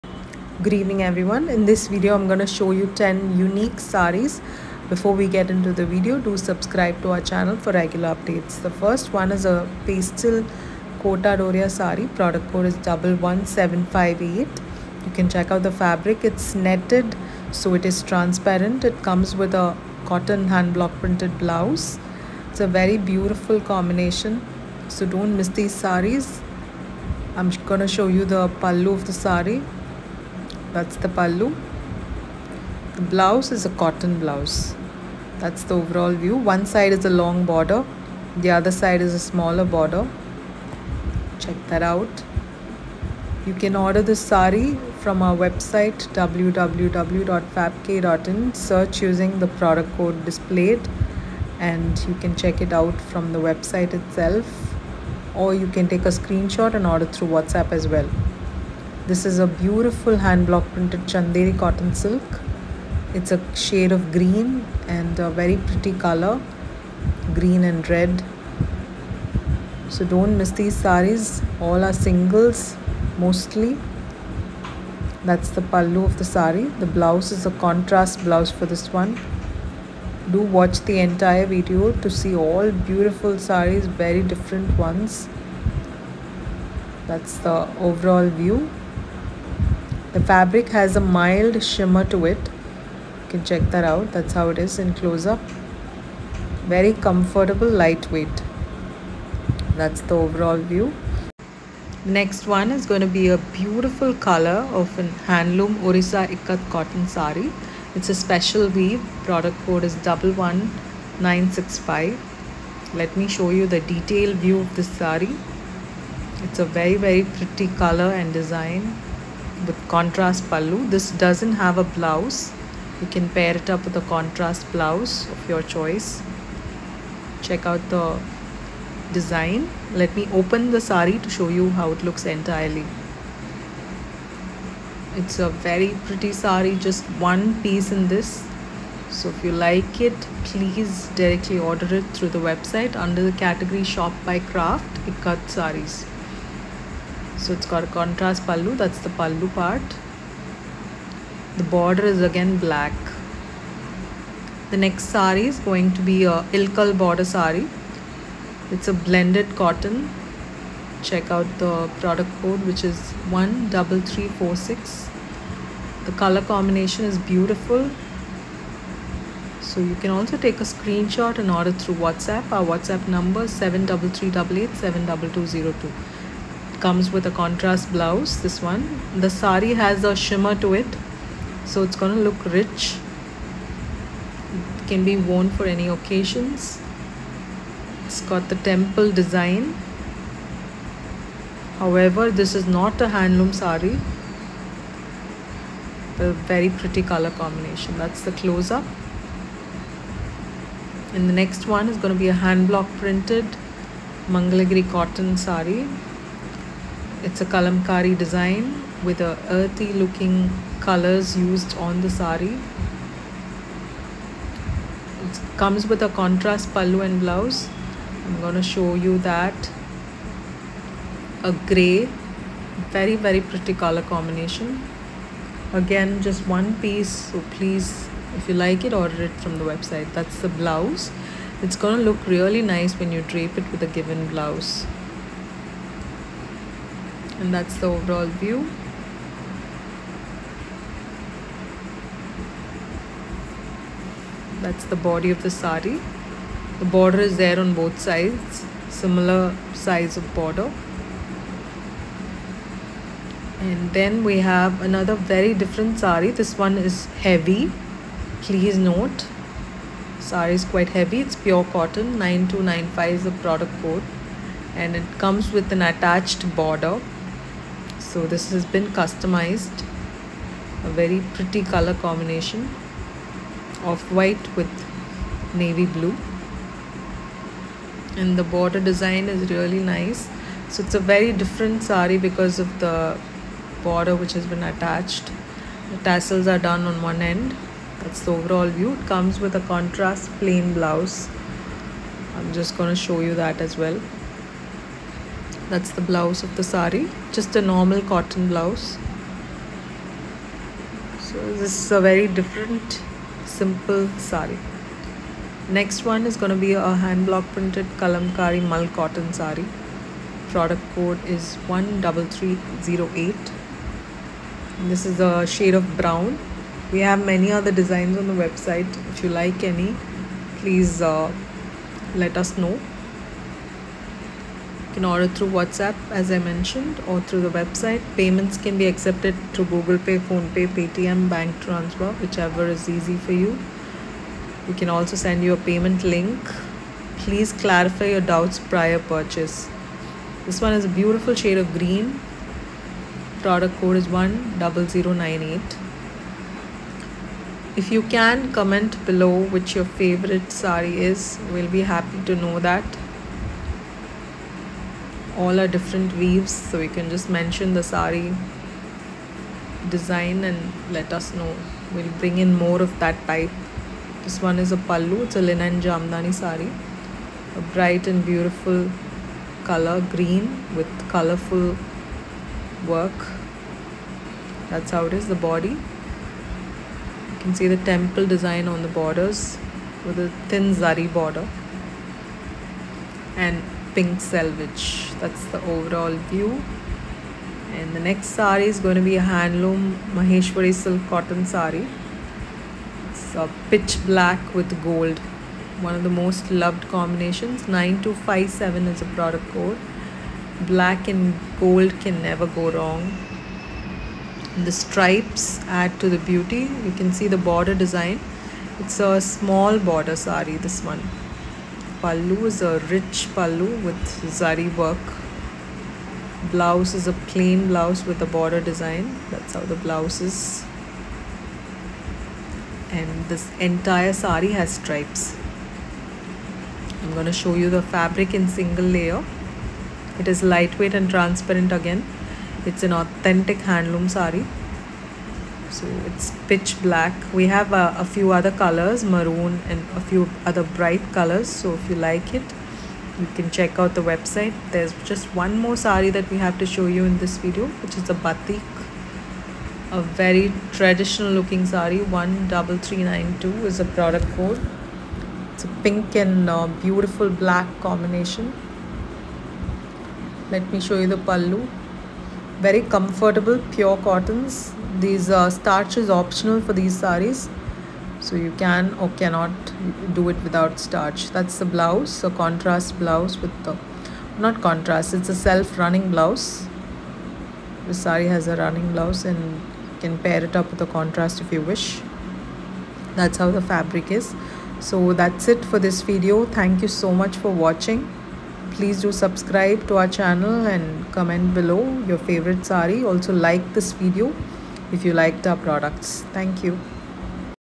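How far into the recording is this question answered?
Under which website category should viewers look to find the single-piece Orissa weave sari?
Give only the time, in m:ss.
2:25.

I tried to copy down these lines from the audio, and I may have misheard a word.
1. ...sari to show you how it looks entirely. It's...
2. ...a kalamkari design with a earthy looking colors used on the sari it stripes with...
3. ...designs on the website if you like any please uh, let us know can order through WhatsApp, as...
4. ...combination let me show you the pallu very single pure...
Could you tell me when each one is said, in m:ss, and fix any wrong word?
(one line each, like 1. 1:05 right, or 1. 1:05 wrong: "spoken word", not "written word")
1. 2:10 right
2. 3:27 wrong: "comes", not "stripes"
3. 5:17 right
4. 7:37 wrong: "comfortable", not "single".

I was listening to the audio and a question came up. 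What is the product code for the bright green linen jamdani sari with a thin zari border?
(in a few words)
10098.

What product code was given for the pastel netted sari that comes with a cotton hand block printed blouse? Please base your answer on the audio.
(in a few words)
11758.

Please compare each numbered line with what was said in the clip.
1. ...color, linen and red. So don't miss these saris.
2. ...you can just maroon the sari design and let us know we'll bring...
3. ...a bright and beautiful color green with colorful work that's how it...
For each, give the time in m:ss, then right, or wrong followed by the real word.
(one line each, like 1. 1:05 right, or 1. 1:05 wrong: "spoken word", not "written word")
1. 1:05 wrong: "green", not "linen"
2. 5:56 wrong: "mention", not "maroon"
3. 6:07 right.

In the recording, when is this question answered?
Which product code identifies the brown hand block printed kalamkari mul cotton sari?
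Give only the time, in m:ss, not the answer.
5:11.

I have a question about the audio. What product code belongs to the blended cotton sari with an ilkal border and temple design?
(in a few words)
13346.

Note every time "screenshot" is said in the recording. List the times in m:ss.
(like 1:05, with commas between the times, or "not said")
0:56, 2:50.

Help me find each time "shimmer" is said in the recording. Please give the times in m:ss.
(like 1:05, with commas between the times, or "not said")
1:31, 3:00.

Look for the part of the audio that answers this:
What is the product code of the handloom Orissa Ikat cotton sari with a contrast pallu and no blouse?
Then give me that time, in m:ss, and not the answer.
1:49.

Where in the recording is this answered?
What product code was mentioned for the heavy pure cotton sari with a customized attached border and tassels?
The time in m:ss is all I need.
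4:22.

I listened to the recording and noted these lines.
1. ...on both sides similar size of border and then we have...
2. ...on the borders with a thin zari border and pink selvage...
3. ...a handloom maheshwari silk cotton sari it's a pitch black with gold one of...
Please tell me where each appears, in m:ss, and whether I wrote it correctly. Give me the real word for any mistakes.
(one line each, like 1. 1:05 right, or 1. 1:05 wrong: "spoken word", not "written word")
1. 4:07 right
2. 6:18 right
3. 6:29 right.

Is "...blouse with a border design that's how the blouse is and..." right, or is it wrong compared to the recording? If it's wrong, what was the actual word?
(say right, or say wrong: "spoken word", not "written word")
right.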